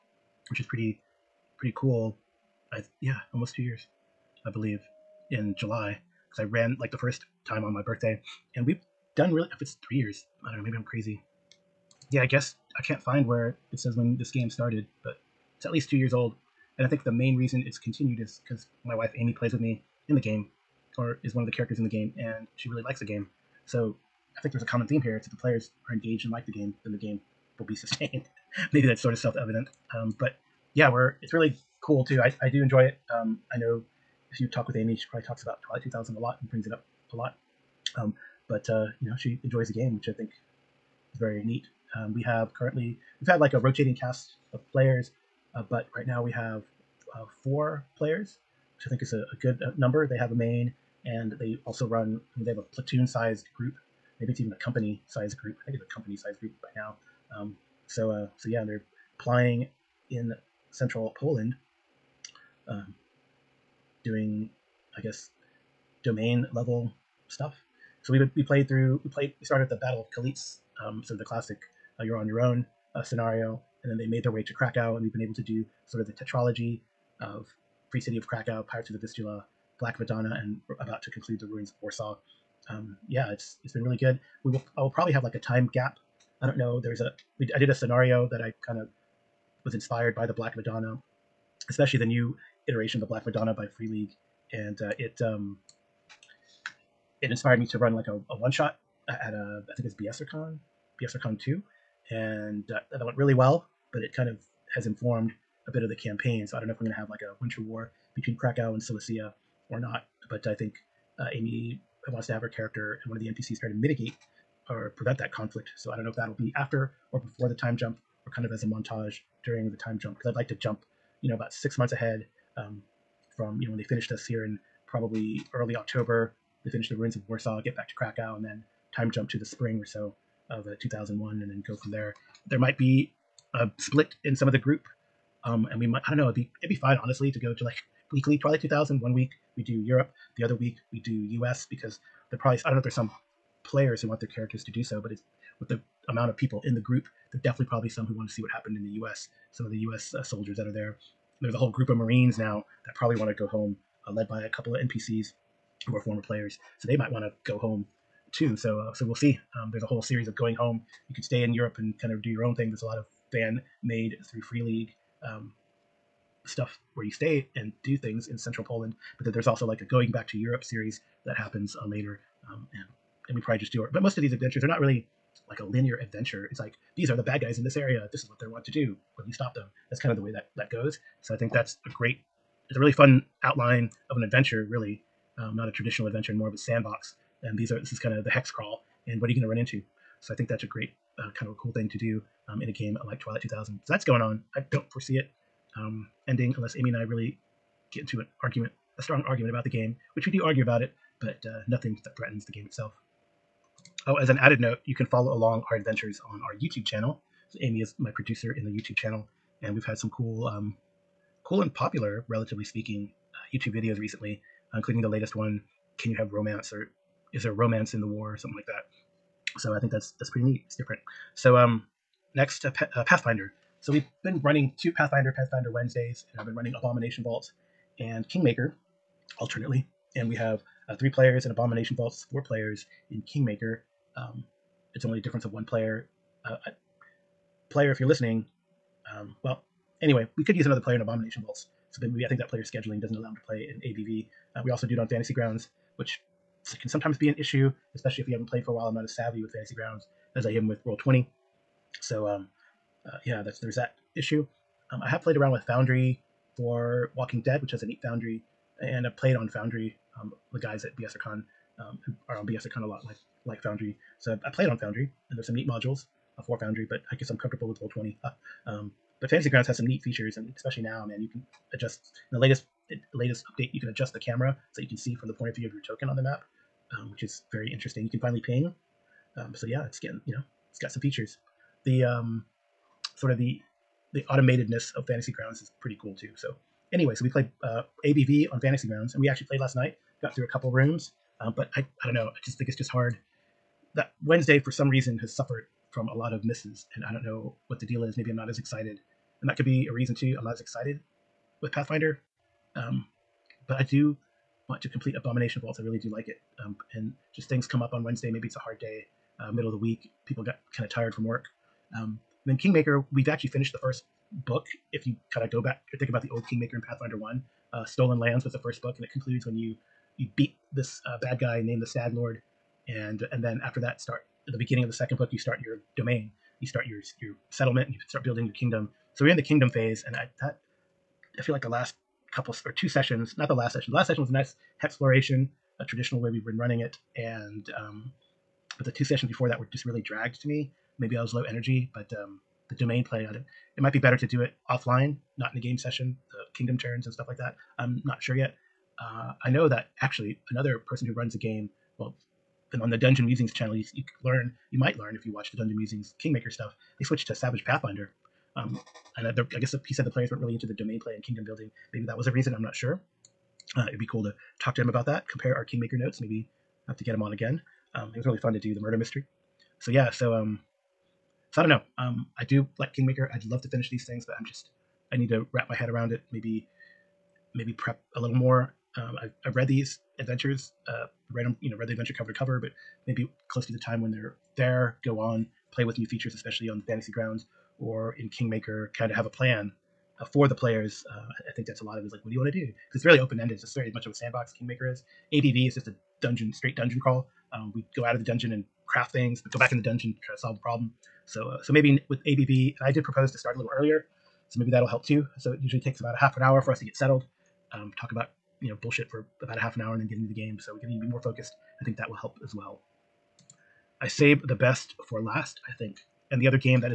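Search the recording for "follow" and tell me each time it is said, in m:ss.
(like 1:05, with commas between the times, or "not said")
3:25.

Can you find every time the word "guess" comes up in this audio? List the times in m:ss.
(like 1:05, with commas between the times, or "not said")
0:12, 1:04, 4:27, 5:59.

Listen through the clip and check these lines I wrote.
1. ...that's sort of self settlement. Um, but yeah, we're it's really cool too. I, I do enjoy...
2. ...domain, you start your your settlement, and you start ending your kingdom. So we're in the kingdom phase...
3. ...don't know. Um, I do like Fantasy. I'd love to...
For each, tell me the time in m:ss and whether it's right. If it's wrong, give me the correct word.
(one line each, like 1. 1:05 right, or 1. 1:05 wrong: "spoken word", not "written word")
1. 0:28 wrong: "evident", not "settlement"
2. 5:25 wrong: "building", not "ending"
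3. 6:11 wrong: "Kingmaker", not "Fantasy".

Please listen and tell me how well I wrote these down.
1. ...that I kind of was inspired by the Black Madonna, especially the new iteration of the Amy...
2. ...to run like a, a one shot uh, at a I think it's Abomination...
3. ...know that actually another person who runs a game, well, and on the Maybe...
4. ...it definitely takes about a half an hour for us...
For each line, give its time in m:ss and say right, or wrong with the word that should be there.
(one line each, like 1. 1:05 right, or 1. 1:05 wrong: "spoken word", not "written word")
1. 1:28 wrong: "Black", not "Amy"
2. 1:37 wrong: "BSRCon", not "Abomination"
3. 5:49 wrong: "Dungeon", not "Maybe"
4. 6:45 wrong: "usually", not "definitely".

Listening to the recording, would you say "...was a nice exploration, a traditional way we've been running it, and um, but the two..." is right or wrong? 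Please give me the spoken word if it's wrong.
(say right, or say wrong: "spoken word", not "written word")
right.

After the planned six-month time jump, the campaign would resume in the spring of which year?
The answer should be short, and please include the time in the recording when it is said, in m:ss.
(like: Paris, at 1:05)
2001, at 2:10.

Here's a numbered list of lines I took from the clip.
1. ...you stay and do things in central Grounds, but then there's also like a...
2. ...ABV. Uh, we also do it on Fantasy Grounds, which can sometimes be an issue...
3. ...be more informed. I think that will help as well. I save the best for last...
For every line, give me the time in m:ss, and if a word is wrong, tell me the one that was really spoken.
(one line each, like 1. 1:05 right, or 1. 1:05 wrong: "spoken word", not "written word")
1. 2:47 wrong: "Poland", not "Grounds"
2. 4:03 right
3. 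6:51 wrong: "focused", not "informed".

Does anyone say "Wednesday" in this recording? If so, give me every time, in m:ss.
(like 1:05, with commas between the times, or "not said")
3:45, 4:54, 5:08.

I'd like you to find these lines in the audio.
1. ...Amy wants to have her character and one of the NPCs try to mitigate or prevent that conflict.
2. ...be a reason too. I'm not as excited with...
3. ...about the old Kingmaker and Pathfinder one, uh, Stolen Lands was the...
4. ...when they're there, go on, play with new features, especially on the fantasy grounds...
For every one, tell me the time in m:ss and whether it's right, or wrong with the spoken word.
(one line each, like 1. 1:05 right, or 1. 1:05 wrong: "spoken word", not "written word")
1. 1:51 right
2. 4:59 right
3. 5:16 right
4. 6:24 right.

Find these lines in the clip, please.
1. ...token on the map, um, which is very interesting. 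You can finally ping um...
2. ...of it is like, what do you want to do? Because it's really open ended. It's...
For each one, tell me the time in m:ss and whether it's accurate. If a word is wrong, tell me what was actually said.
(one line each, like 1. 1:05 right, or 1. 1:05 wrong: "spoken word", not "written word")
1. 4:35 right
2. 6:31 right.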